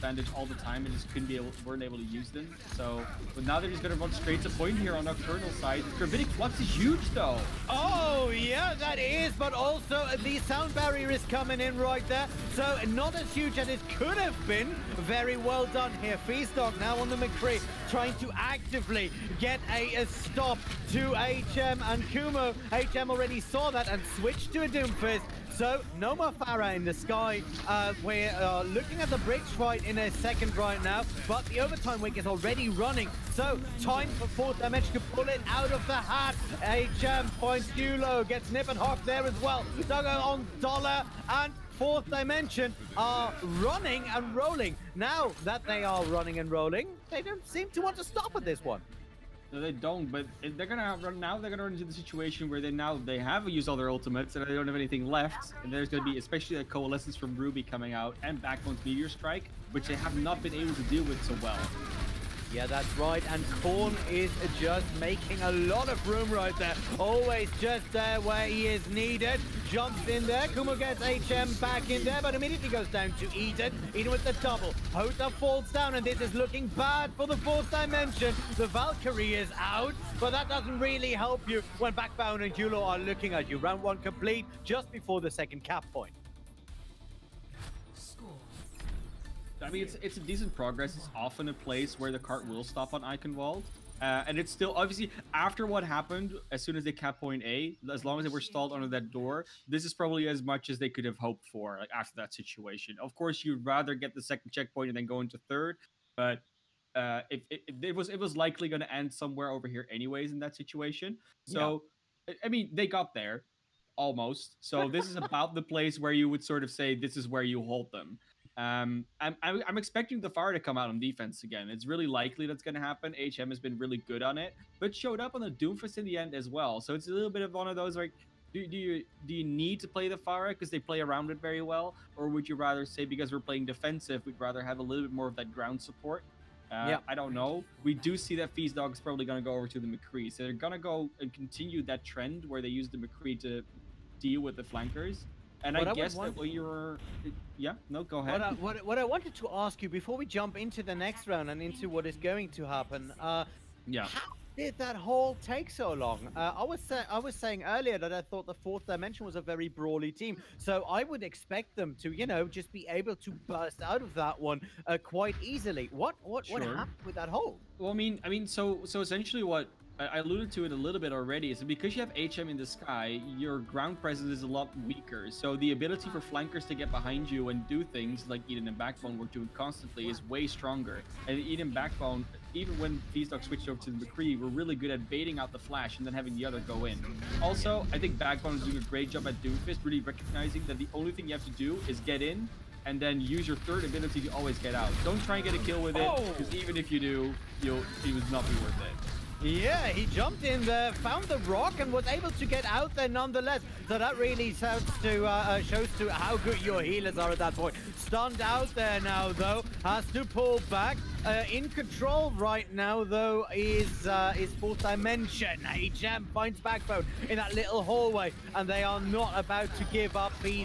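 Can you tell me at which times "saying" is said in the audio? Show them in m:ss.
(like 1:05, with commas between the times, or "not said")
2:37.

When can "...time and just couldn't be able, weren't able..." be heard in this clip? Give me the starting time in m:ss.
0:00.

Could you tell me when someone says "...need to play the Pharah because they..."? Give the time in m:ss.
2:09.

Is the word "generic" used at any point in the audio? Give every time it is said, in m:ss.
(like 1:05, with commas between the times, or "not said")
not said.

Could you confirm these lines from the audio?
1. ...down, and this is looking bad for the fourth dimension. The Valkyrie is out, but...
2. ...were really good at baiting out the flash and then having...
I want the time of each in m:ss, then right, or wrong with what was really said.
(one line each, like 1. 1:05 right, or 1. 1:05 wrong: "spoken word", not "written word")
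1. 1:15 right
2. 3:04 right.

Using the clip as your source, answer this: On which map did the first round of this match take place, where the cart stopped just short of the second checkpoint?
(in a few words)
Eichenwald.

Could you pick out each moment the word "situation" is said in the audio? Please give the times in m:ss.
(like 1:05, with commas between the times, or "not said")
0:51, 1:42, 1:50.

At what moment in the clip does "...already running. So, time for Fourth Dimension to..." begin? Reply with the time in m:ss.
0:32.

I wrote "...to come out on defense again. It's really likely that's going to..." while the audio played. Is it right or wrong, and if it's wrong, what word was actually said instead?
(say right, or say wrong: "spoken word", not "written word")
right.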